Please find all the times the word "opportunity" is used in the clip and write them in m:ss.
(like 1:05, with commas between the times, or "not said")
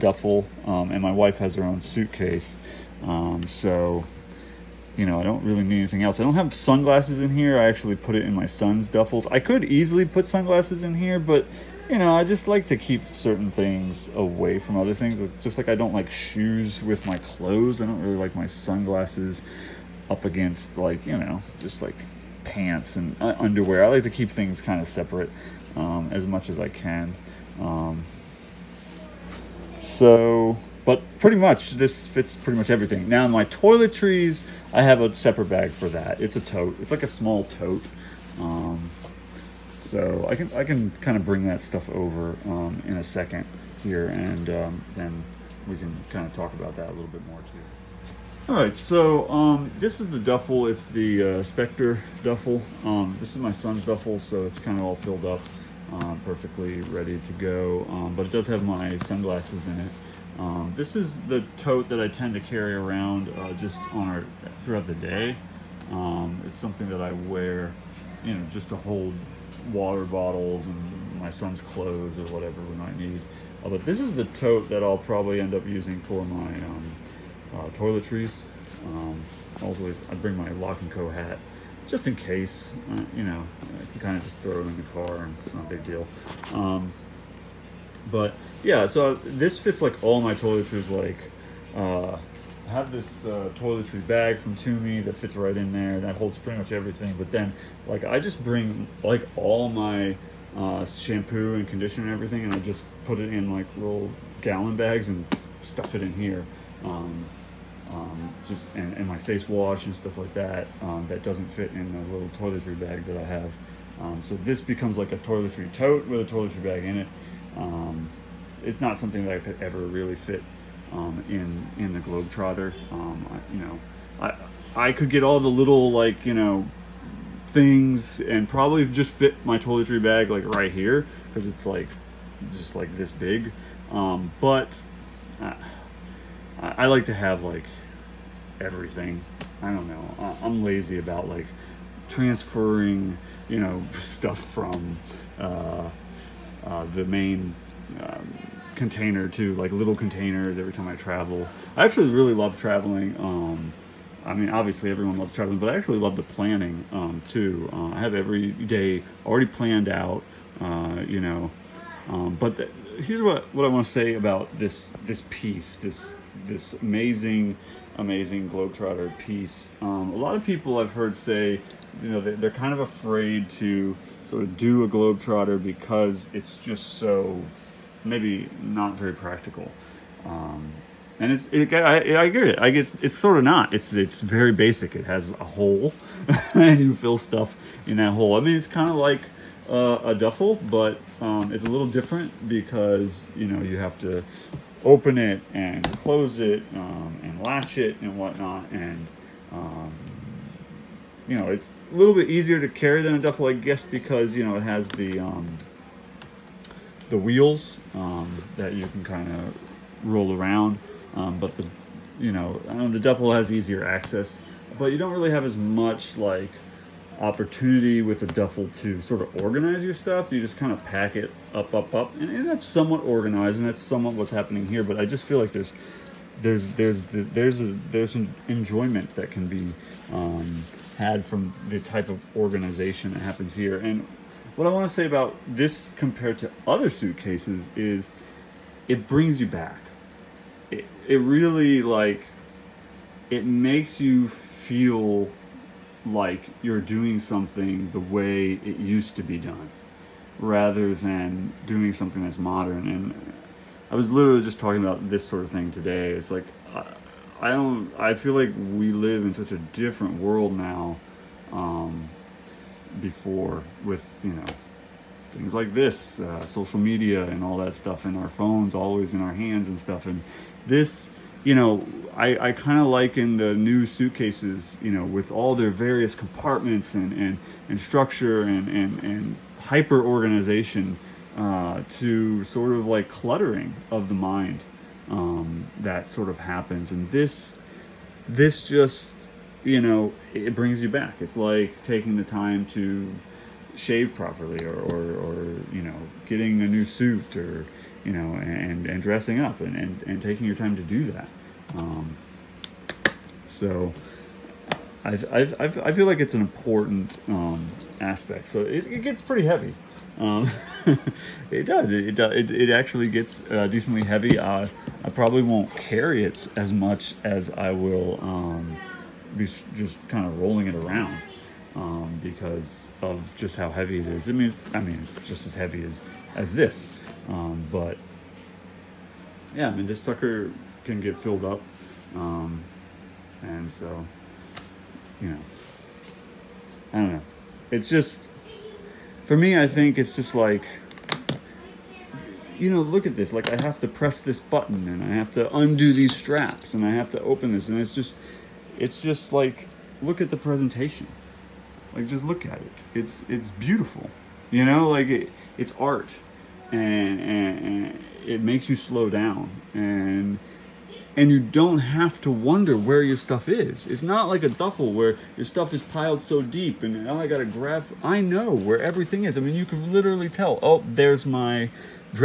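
3:37.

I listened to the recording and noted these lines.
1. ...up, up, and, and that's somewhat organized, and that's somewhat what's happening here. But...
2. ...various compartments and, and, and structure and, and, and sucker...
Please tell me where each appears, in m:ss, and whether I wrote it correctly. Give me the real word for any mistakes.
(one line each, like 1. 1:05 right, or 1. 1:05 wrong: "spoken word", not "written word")
1. 3:41 right
2. 4:35 wrong: "hyper", not "sucker".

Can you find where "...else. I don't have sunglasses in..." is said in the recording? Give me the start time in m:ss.
0:06.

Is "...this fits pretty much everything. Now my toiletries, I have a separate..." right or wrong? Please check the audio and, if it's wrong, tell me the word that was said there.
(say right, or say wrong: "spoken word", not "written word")
right.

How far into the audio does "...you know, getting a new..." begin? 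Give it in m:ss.
4:55.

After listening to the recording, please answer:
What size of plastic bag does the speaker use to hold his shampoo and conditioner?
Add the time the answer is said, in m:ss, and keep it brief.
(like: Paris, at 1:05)
Gallon, at 1:44.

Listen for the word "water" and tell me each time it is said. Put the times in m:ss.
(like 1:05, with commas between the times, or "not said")
1:09.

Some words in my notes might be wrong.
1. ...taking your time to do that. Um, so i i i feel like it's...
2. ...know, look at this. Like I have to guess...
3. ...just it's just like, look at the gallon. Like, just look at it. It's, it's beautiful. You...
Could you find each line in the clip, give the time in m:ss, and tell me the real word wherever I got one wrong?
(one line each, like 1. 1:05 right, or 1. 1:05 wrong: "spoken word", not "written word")
1. 5:00 right
2. 5:42 wrong: "press", not "guess"
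3. 5:47 wrong: "presentation", not "gallon".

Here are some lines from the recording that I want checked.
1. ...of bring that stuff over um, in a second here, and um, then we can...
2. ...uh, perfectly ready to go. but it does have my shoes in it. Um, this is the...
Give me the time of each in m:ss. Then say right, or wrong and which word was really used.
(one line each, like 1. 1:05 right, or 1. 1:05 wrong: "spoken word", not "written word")
1. 0:41 right
2. 0:55 wrong: "sunglasses", not "shoes".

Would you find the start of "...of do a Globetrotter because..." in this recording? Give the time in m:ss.
2:54.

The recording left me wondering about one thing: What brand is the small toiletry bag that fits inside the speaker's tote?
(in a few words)
Tumi.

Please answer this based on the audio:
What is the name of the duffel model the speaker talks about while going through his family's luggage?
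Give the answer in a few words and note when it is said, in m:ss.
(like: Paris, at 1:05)
Spectre, at 0:51.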